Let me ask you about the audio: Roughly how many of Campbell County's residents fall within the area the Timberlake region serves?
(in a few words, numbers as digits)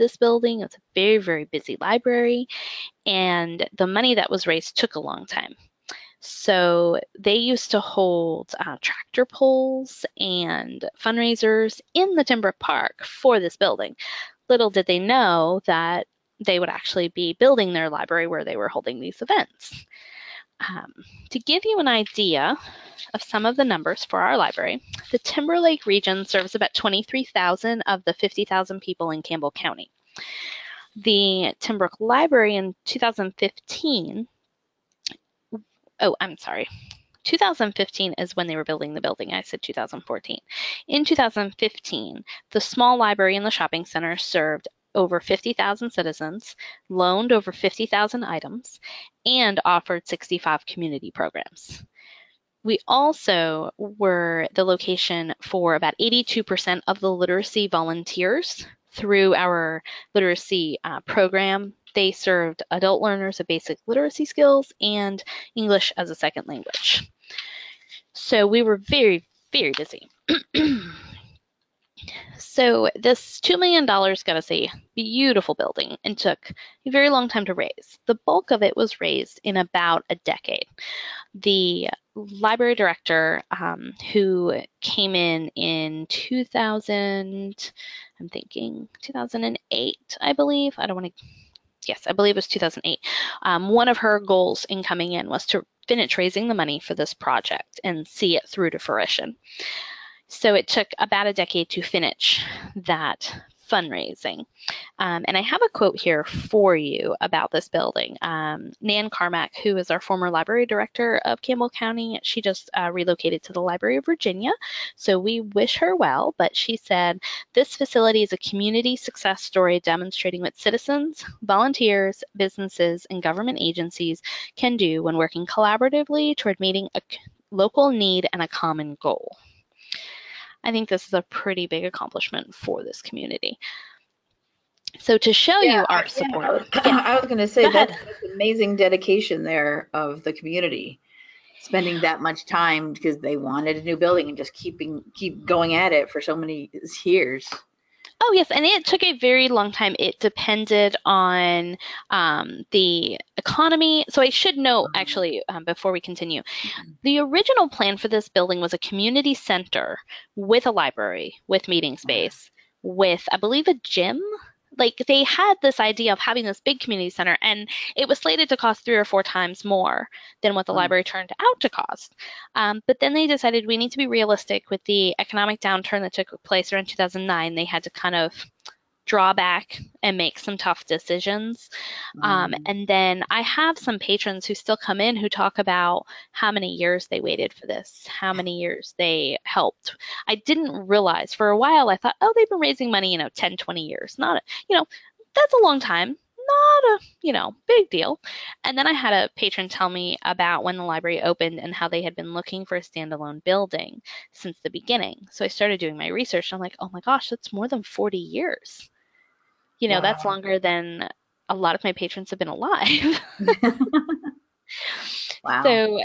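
23,000.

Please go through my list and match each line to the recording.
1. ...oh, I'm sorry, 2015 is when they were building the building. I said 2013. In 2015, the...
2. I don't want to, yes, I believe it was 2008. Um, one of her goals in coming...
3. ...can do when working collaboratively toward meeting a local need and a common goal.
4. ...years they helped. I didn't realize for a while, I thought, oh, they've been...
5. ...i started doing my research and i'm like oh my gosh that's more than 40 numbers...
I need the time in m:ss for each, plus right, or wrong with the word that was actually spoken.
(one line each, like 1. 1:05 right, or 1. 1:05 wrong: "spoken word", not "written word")
1. 0:35 wrong: "2014", not "2013"
2. 1:30 right
3. 2:04 right
4. 3:08 right
5. 3:25 wrong: "years", not "numbers".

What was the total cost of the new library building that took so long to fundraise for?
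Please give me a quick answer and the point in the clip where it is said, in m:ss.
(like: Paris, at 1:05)
$2 million, at 1:13.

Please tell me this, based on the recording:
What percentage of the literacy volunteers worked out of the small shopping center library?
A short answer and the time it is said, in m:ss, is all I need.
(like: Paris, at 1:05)
82%, at 0:56.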